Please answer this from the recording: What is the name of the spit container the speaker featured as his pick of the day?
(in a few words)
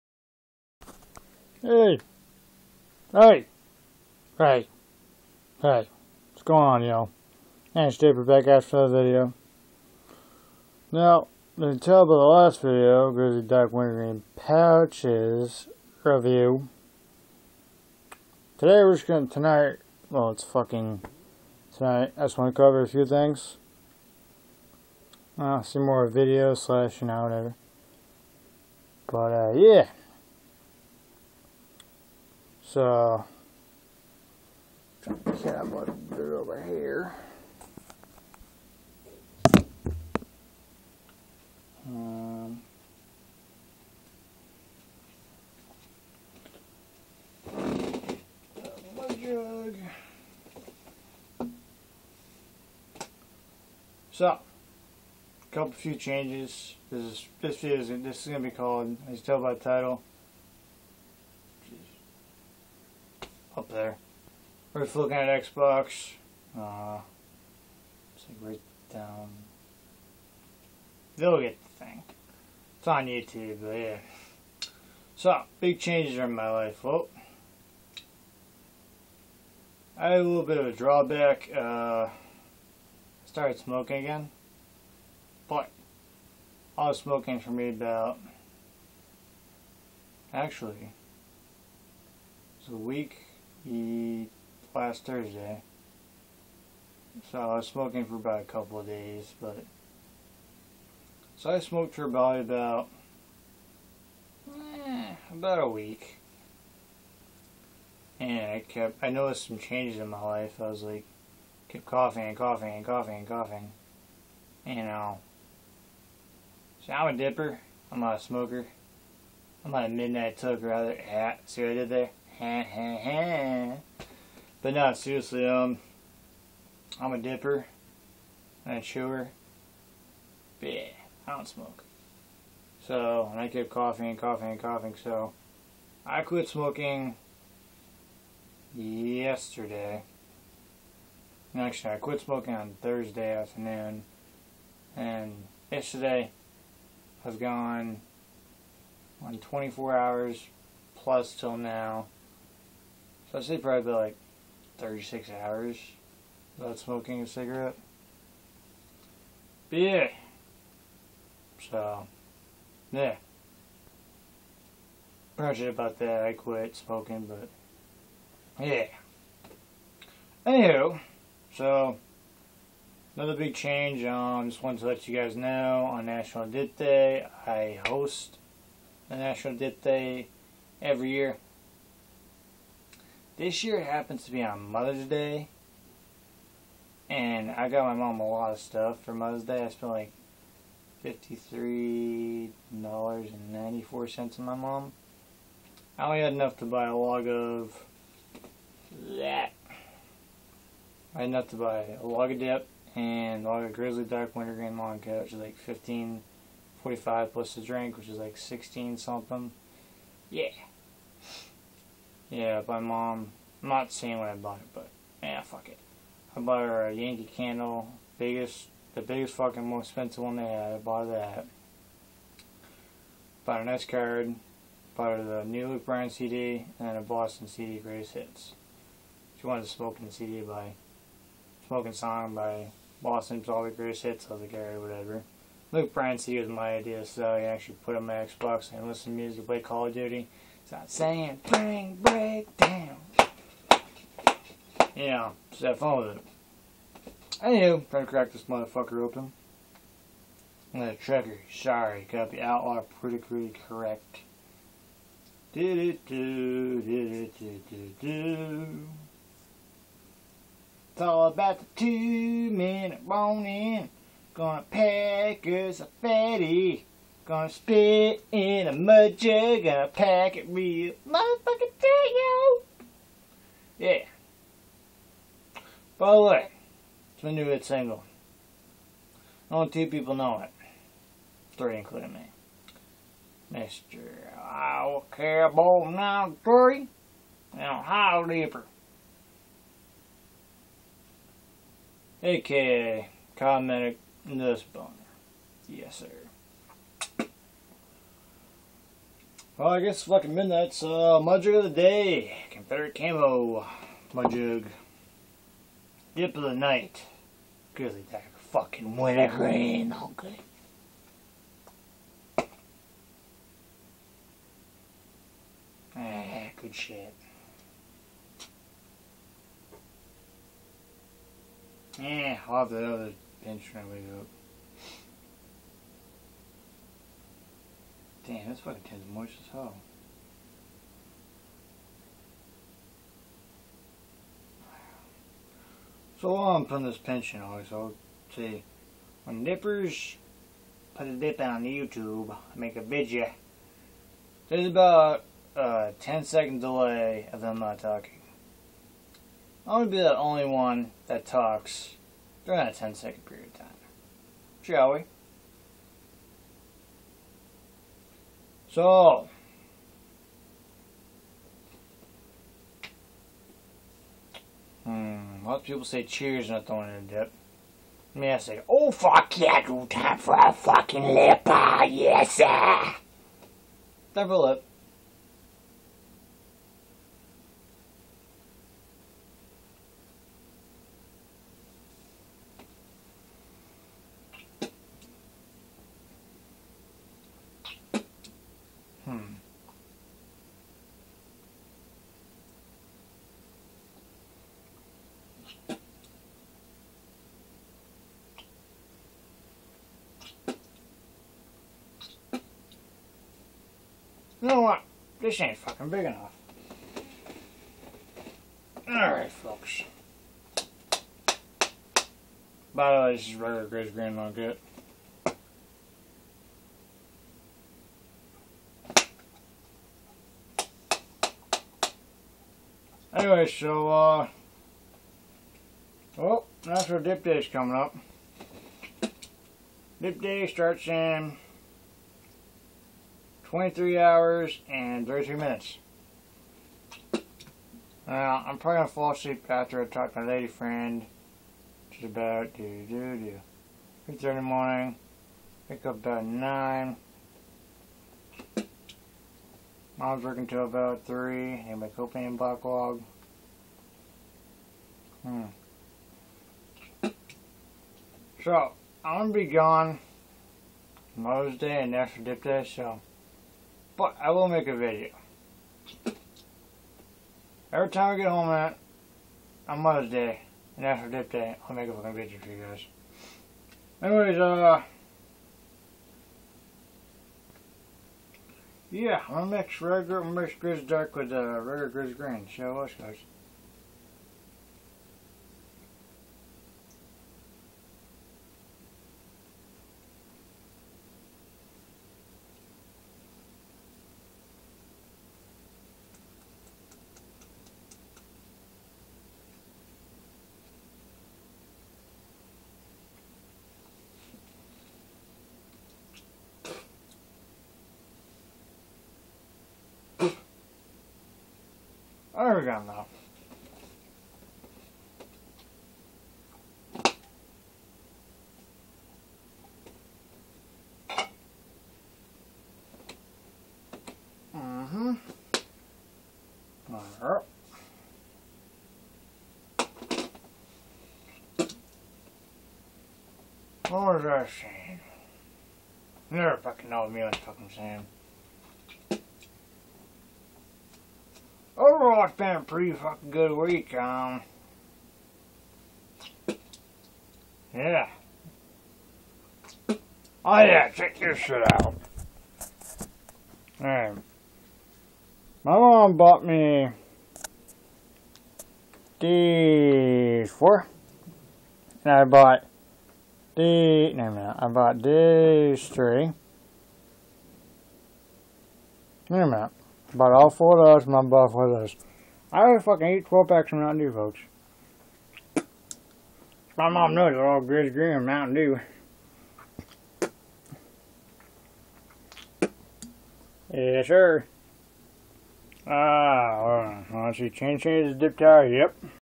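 Confederate Camo.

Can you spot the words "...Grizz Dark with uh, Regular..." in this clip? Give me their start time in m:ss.
8:00.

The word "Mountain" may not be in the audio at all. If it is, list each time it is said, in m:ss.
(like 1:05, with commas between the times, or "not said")
9:33, 9:38.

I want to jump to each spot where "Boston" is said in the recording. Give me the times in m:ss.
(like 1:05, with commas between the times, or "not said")
3:47, 3:53.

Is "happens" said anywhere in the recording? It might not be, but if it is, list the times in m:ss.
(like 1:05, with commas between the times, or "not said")
3:03.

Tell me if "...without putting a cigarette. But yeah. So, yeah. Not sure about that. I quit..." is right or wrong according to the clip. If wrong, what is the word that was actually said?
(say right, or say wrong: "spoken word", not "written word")
wrong: "smoking", not "putting".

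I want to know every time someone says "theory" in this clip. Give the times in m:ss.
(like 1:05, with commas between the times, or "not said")
not said.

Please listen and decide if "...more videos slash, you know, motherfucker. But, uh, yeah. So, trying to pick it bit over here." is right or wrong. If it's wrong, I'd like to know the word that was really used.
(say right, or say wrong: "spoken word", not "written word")
wrong: "whatever", not "motherfucker".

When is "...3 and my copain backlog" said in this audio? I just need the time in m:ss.
7:31.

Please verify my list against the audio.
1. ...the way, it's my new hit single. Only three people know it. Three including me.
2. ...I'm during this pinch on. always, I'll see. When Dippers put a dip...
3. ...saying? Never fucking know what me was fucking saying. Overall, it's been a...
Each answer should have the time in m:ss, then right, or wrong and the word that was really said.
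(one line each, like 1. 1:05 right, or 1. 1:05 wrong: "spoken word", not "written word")
1. 4:36 wrong: "two", not "three"
2. 5:36 wrong: "putting", not "during"
3. 8:54 right.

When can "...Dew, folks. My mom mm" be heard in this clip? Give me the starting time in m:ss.
9:33.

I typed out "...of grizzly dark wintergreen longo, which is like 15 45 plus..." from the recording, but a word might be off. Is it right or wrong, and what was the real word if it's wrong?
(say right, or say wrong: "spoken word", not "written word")
right.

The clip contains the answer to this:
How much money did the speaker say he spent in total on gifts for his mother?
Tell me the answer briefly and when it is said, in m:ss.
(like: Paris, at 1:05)
$53.94, at 3:11.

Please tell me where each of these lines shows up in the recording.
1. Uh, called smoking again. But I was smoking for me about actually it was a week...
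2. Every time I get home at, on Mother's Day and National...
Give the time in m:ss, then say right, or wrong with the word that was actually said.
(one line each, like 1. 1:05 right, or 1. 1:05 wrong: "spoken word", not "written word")
1. 1:21 wrong: "started", not "called"
2. 7:47 right.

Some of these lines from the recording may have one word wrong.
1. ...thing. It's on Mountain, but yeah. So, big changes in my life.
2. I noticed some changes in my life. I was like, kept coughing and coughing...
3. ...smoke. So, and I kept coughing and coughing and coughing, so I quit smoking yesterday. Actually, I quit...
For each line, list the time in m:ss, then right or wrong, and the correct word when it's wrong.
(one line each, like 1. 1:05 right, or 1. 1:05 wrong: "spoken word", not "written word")
1. 1:11 wrong: "YouTube", not "Mountain"
2. 1:49 right
3. 2:11 right.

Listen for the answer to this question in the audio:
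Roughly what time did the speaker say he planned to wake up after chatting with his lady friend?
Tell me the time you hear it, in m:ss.
7:25.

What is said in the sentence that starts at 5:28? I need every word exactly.
Damn, that's fucking tin's moist as hell.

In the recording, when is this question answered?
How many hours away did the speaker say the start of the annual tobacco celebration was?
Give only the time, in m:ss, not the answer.
7:13.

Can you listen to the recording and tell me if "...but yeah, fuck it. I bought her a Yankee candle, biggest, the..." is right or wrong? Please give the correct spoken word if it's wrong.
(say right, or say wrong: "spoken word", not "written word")
right.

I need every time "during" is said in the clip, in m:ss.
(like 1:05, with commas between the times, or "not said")
5:52.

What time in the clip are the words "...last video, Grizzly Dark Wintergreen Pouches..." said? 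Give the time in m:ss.
0:12.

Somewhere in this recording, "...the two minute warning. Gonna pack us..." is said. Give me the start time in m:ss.
4:21.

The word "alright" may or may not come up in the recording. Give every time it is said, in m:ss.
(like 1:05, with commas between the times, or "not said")
3:54, 6:48, 9:13.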